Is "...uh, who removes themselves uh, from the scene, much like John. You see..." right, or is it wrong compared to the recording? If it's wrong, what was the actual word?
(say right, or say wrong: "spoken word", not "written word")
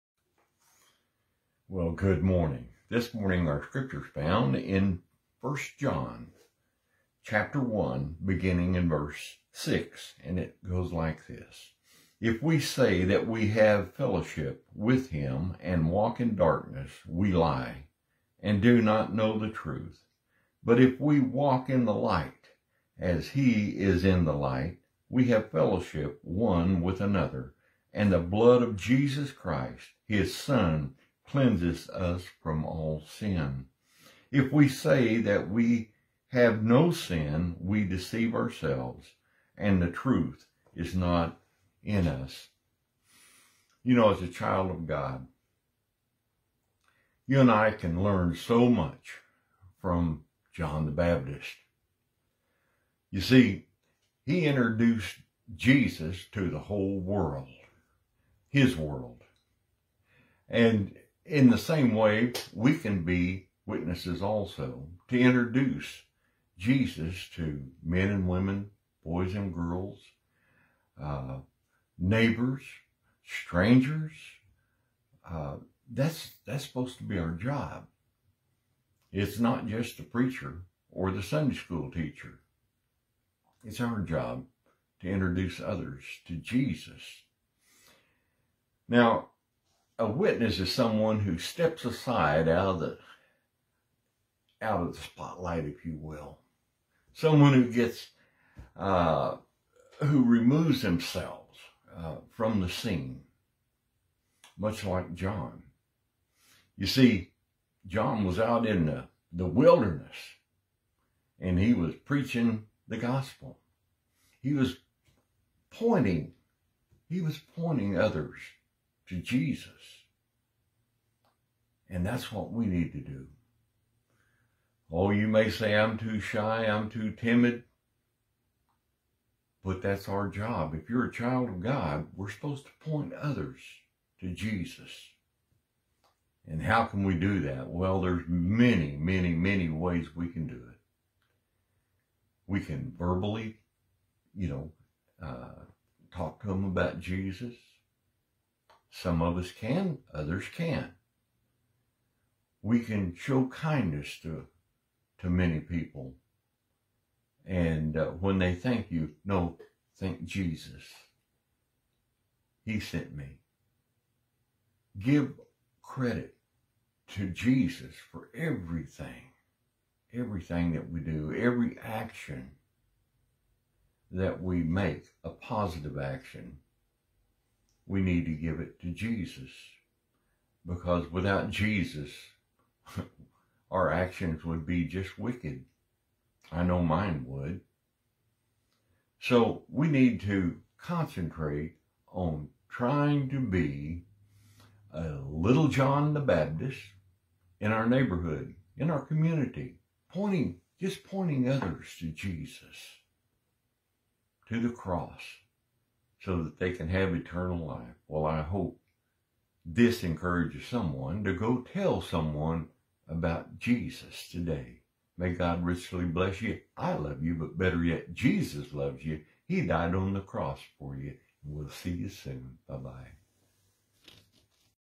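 right.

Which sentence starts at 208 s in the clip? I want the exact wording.
Well, I hope this encourages someone to go tell someone about Jesus today.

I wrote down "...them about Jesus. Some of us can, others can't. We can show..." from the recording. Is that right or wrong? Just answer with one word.
right.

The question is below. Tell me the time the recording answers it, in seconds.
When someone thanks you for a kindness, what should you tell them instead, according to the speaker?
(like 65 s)
159 s.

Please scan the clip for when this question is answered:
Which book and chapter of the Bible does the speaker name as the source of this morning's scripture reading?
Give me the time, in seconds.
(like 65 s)
5 s.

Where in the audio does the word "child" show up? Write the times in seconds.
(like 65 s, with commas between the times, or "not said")
44 s, 131 s.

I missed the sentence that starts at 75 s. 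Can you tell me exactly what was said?
Uh, that's that's supposed to be our job.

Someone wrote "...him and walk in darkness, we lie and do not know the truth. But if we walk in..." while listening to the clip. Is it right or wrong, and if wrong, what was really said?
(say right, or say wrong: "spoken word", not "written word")
right.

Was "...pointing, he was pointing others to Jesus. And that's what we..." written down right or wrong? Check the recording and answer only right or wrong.
right.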